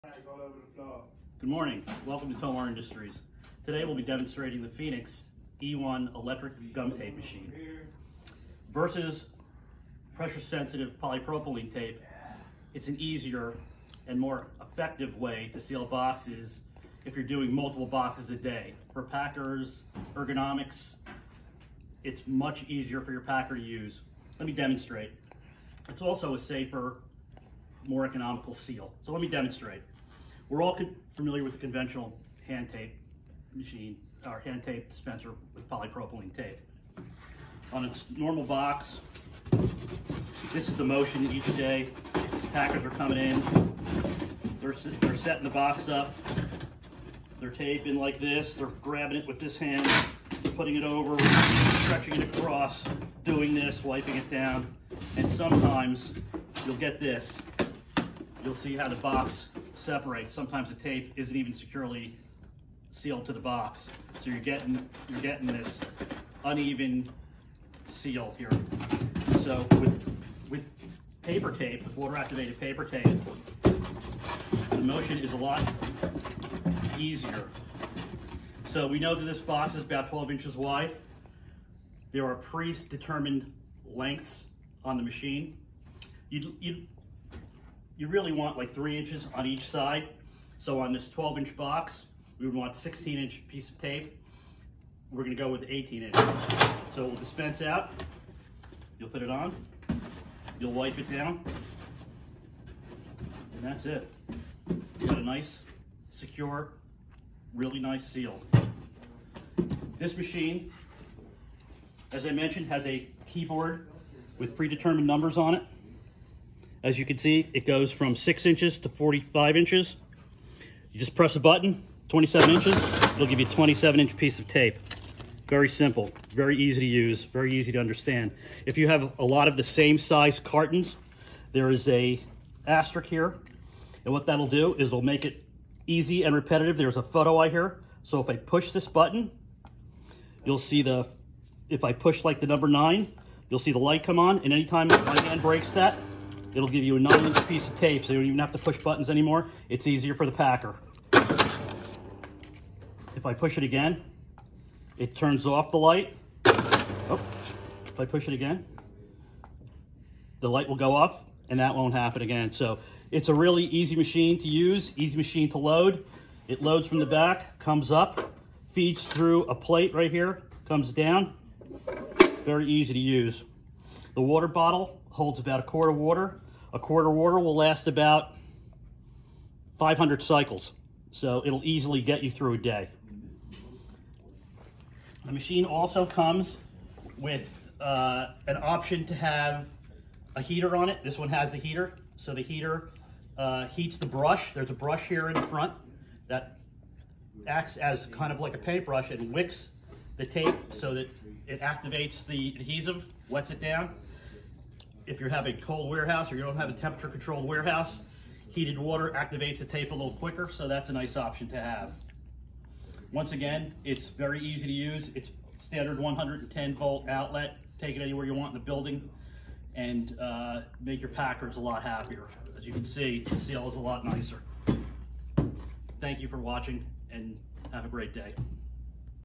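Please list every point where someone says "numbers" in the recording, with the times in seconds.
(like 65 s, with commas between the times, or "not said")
115 s, 142 s.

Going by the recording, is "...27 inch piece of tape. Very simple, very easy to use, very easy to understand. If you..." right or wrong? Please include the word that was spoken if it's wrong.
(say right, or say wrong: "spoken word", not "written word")
right.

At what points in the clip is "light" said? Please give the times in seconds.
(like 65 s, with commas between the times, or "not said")
143 s, 155 s, 160 s.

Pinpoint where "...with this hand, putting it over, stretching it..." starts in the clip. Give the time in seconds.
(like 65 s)
49 s.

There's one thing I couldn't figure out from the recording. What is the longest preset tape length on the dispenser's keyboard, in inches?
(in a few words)
45 inches.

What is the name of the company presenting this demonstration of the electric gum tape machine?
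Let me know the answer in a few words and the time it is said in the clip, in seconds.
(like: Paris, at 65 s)
Tomar Industries, at 2 s.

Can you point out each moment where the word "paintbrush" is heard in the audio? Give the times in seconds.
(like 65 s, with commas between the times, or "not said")
198 s.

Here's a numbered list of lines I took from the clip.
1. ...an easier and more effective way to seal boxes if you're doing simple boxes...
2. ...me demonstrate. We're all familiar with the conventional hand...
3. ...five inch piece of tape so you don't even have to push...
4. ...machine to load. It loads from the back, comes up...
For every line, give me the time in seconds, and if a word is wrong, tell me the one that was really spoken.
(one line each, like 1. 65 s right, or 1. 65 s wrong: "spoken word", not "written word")
1. 12 s wrong: "multiple", not "simple"
2. 29 s right
3. 146 s wrong: "nine", not "five"
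4. 165 s right.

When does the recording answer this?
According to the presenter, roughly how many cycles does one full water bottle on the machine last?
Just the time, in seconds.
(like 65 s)
179 s.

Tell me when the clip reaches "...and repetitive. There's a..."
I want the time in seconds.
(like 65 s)
136 s.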